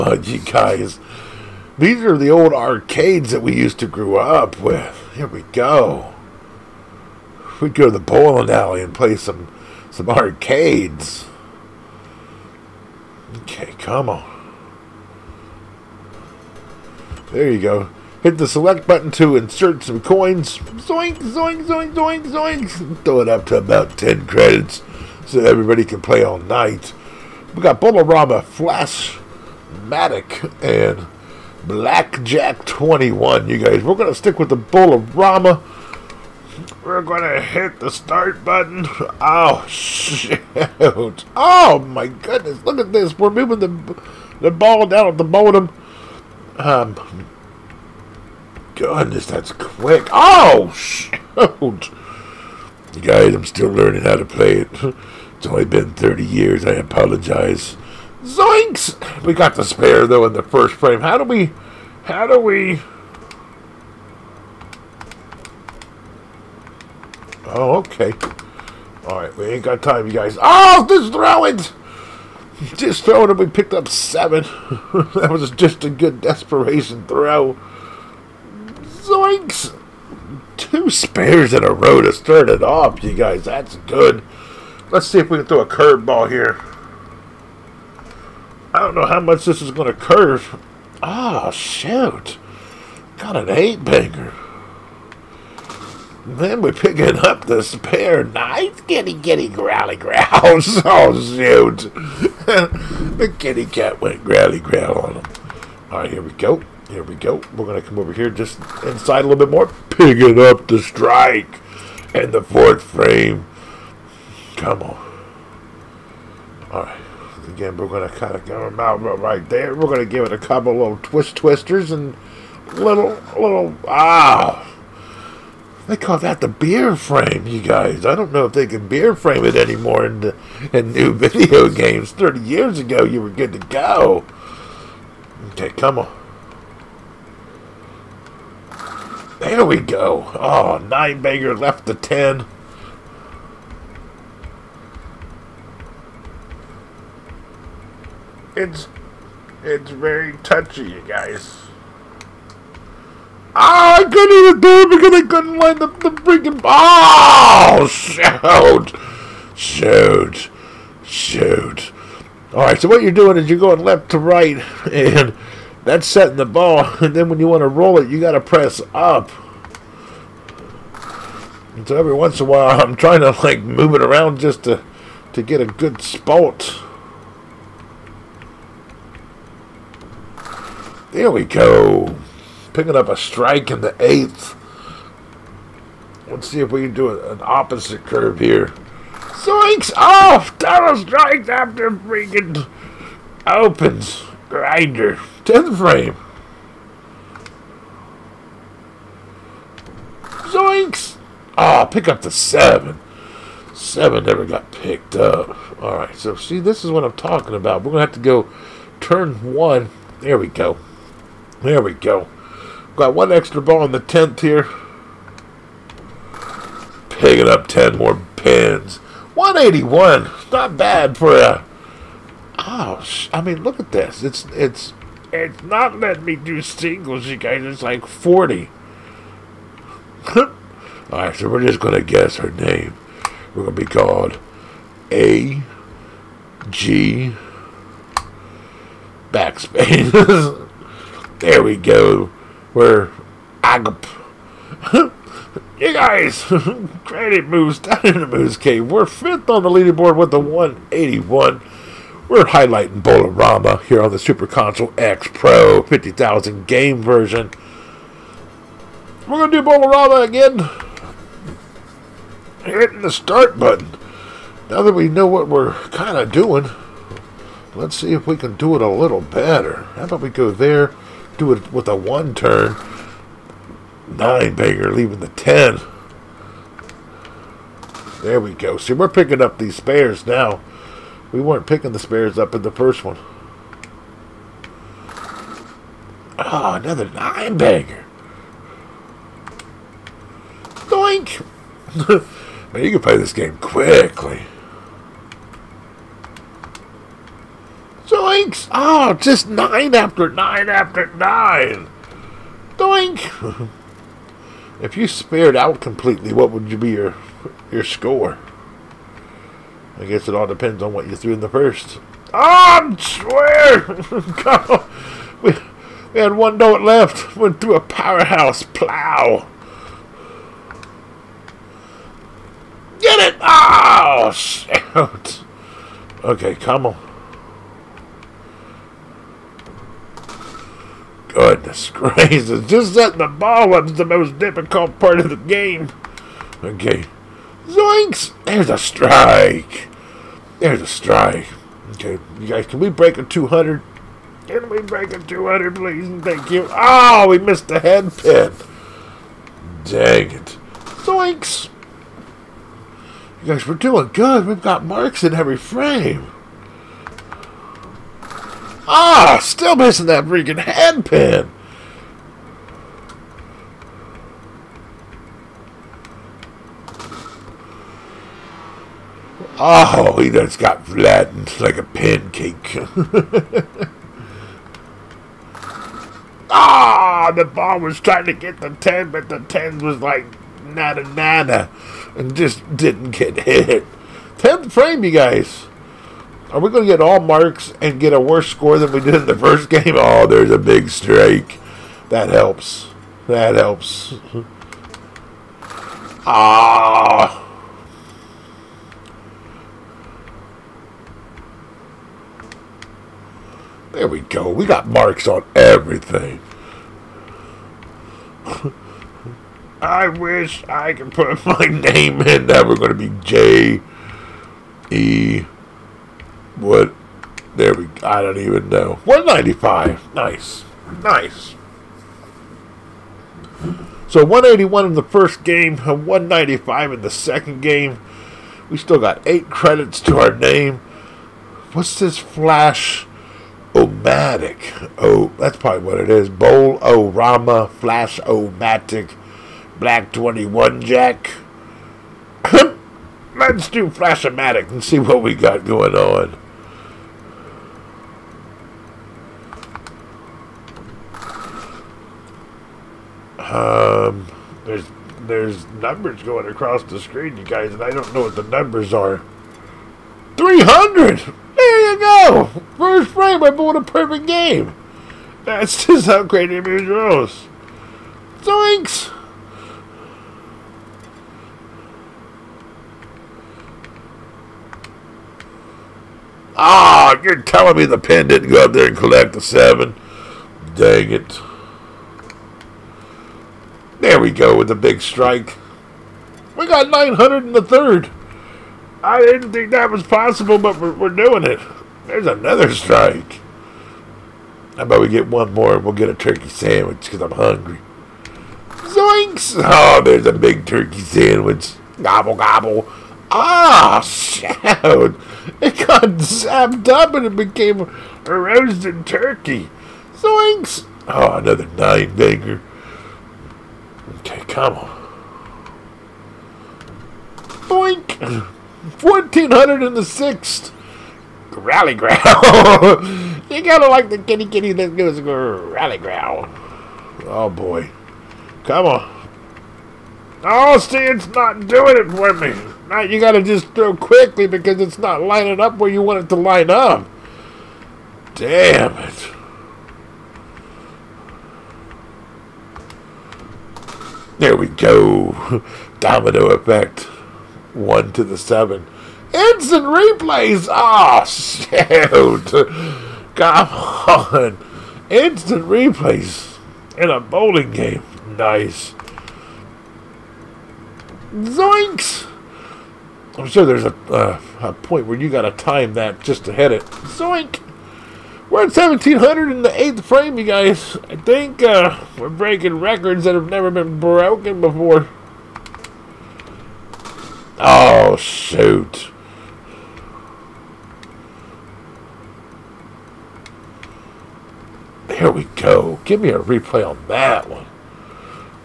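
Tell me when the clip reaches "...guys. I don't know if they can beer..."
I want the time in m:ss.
2:07.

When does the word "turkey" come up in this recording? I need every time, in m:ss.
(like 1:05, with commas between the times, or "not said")
8:16, 8:20, 8:29.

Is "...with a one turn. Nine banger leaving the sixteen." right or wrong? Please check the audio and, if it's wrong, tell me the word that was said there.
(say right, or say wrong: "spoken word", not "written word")
wrong: "ten", not "sixteen".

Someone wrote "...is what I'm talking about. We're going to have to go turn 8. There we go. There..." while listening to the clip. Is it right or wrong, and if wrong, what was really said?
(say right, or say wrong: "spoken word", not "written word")
wrong: "1", not "8".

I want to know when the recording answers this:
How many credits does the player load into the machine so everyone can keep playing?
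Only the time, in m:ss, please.
0:23.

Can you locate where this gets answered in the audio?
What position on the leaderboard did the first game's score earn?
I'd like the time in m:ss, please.
4:09.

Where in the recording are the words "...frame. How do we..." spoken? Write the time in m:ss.
1:00.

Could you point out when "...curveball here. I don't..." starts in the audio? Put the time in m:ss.
1:25.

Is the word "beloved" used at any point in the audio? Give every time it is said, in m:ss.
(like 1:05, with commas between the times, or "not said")
not said.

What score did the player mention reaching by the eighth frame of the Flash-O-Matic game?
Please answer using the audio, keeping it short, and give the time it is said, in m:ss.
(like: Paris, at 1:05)
1700, at 9:28.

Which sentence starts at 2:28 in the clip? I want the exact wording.
It's it's very touchy, you guys.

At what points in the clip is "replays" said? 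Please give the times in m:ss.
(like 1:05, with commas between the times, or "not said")
9:09, 9:15, 9:46.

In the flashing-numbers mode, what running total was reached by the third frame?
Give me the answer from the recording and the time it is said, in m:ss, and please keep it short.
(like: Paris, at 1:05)
900, at 8:06.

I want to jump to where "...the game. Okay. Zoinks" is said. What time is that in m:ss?
5:35.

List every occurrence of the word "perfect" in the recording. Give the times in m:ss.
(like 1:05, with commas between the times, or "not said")
7:43.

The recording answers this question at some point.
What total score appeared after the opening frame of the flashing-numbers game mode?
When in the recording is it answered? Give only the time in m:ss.
7:40.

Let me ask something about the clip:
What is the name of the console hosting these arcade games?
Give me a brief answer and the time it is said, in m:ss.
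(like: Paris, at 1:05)
Super Console X Pro, at 4:14.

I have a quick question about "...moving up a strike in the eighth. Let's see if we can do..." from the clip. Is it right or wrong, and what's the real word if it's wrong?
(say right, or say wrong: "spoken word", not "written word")
wrong: "picking", not "moving".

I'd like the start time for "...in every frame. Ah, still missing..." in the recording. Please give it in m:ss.
5:55.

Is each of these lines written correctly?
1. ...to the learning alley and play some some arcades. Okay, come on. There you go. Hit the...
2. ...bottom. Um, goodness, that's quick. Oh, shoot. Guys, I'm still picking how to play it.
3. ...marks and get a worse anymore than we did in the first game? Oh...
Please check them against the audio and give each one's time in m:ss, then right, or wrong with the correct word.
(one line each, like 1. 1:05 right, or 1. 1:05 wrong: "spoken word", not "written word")
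1. 0:07 wrong: "bowling", not "learning"
2. 0:45 wrong: "learning", not "picking"
3. 6:27 wrong: "score", not "anymore".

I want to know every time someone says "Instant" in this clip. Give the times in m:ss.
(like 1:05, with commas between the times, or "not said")
9:09, 9:15.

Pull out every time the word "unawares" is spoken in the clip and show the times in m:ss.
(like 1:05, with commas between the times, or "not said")
not said.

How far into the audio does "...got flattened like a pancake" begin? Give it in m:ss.
6:10.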